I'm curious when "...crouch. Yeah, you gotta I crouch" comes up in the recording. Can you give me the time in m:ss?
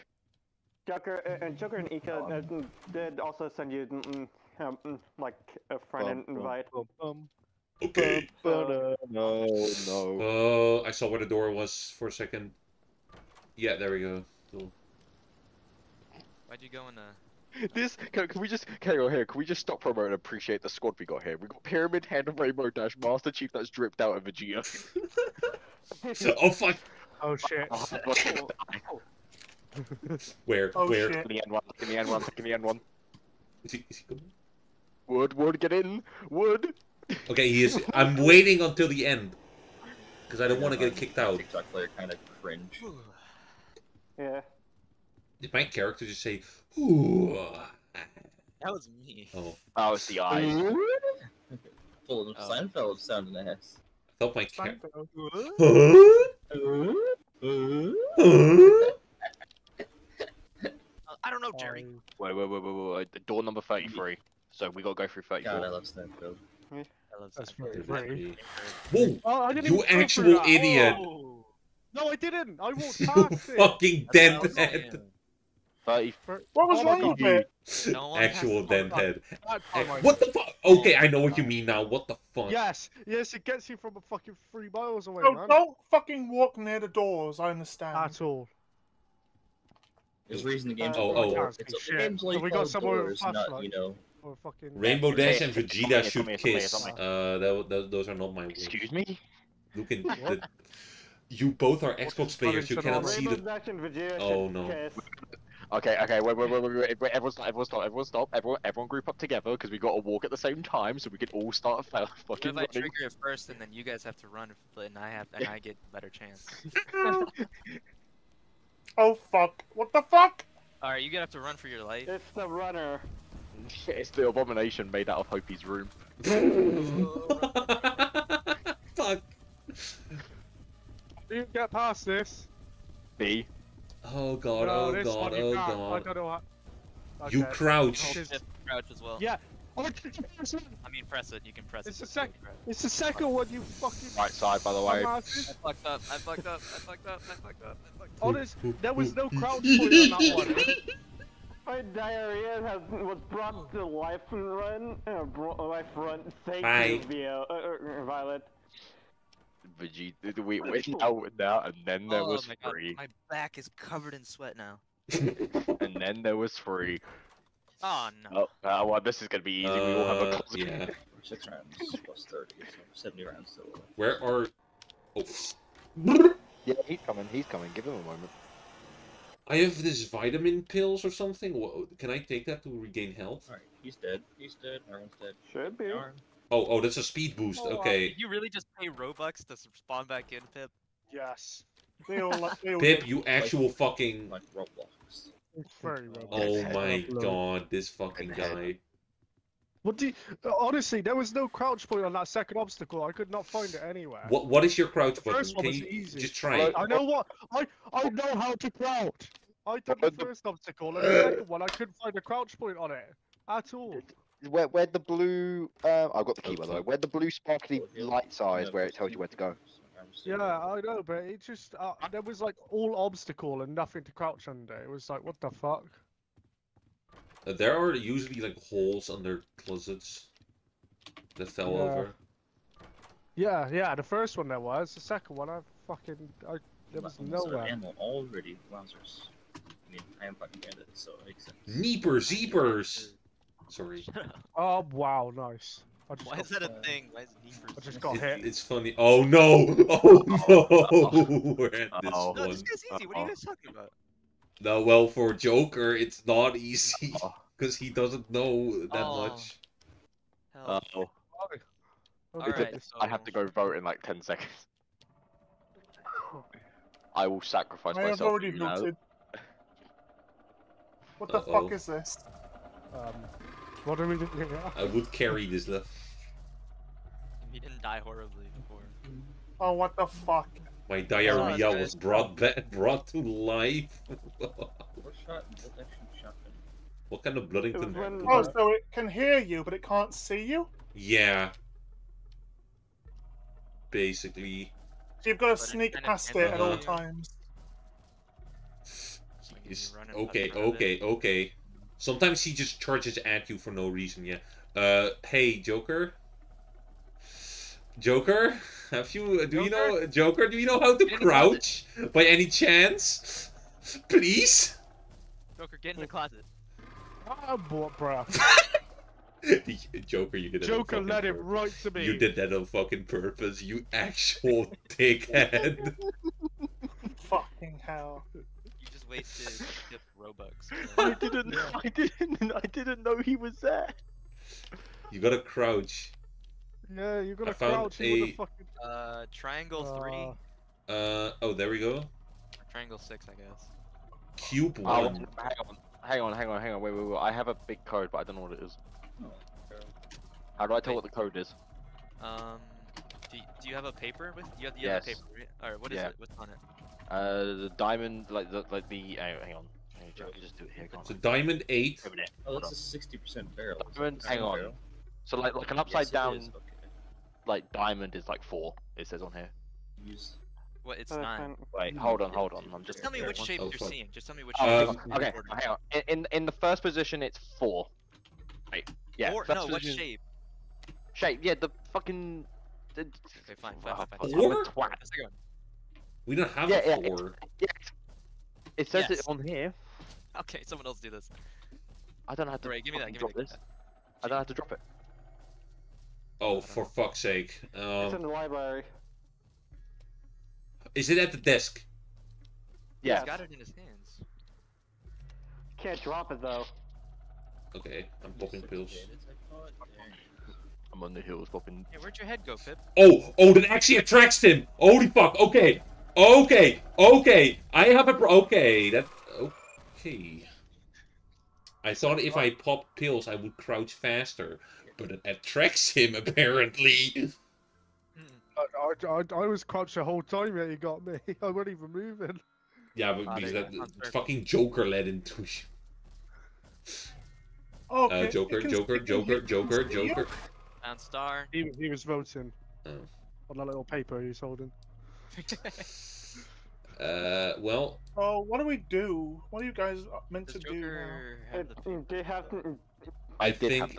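5:35.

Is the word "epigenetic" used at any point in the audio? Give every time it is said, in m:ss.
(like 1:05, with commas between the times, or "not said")
not said.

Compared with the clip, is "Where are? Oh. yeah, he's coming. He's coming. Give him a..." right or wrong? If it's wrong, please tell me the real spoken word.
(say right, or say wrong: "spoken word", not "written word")
right.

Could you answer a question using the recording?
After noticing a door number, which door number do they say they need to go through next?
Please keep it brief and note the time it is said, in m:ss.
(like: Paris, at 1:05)
34, at 1:05.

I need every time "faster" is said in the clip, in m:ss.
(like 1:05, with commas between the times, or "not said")
7:03.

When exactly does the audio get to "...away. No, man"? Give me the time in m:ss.
1:25.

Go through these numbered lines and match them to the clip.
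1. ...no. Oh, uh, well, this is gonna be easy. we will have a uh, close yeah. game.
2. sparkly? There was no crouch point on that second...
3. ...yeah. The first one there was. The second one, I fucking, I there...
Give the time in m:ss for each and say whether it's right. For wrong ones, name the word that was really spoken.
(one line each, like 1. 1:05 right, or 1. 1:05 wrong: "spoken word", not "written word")
1. 2:48 right
2. 3:20 wrong: "honestly", not "sparkly"
3. 3:53 right.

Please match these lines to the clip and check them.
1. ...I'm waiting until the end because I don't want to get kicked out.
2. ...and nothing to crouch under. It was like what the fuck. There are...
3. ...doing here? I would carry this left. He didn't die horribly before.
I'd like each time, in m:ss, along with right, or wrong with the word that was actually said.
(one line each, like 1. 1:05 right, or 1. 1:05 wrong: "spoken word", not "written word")
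1. 0:37 right
2. 3:43 right
3. 4:34 right.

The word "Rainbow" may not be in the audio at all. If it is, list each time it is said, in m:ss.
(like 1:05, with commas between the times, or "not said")
0:22, 1:34, 1:43.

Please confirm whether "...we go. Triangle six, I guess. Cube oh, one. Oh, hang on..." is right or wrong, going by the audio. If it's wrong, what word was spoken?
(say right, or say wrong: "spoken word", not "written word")
right.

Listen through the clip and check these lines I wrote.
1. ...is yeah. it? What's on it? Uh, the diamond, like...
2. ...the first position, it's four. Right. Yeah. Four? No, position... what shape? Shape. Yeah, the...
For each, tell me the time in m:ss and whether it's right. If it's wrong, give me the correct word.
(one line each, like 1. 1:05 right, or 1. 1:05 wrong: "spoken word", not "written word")
1. 5:55 right
2. 6:16 right.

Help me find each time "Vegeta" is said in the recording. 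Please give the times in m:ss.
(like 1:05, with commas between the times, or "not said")
0:24, 1:35, 1:43, 2:39.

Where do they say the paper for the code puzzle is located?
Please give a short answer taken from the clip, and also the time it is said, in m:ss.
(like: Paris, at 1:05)
The library, at 6:38.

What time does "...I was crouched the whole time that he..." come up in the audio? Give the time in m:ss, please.
7:09.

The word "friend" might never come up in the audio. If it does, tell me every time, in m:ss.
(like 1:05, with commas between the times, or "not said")
0:05.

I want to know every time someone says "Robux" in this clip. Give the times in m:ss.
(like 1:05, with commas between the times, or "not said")
3:08, 5:30.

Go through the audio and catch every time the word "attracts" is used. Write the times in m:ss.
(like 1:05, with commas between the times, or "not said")
6:53, 7:05.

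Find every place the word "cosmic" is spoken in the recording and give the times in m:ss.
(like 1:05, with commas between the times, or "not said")
not said.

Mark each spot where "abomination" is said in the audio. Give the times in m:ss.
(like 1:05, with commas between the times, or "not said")
2:04.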